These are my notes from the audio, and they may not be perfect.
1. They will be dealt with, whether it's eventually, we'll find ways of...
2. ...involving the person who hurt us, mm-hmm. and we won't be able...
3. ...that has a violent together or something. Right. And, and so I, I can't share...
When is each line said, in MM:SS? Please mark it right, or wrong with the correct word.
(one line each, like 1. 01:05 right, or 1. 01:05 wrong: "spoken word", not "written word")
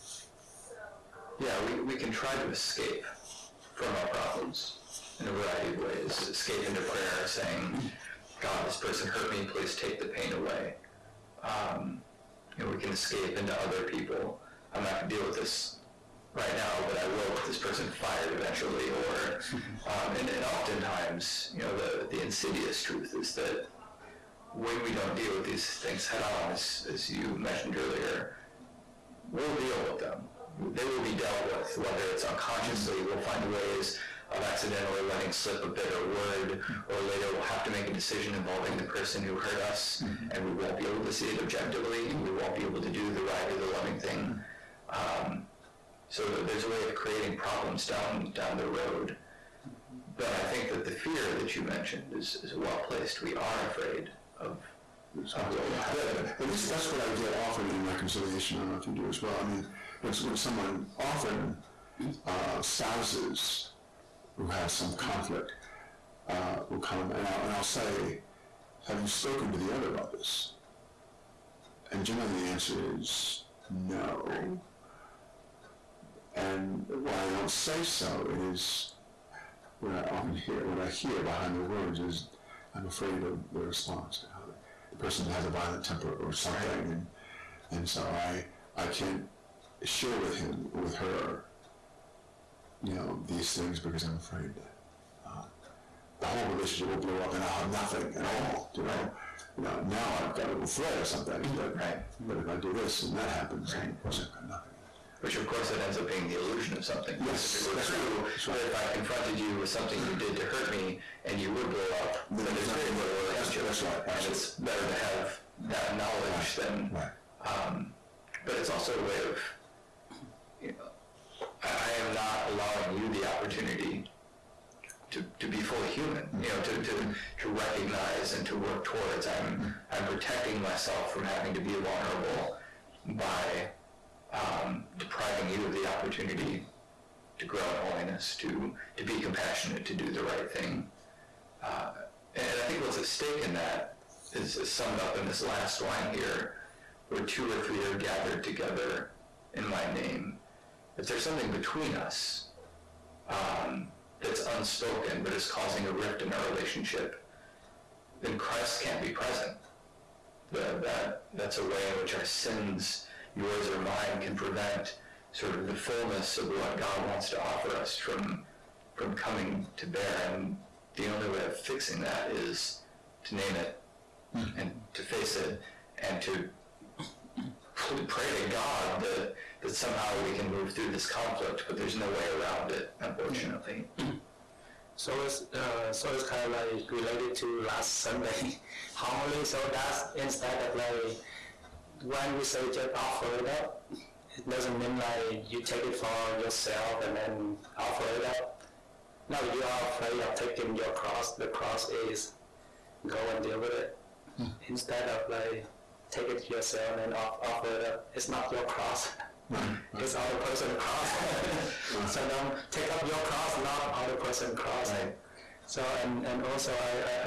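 1. 00:30 wrong: "unconsciously", not "eventually"
2. 00:38 right
3. 01:25 wrong: "temper", not "together".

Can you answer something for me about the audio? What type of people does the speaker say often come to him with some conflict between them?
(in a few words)
Spouses.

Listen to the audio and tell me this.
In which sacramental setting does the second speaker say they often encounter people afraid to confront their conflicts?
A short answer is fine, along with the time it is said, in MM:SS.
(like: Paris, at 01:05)
Reconciliation, at 00:57.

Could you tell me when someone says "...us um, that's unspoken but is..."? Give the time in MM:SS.
02:31.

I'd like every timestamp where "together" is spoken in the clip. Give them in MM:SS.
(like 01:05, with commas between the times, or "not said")
02:28.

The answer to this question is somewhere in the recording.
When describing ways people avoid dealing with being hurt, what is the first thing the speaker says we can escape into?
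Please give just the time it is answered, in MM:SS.
00:06.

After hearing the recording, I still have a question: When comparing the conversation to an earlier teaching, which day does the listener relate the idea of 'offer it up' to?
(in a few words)
Last Sunday.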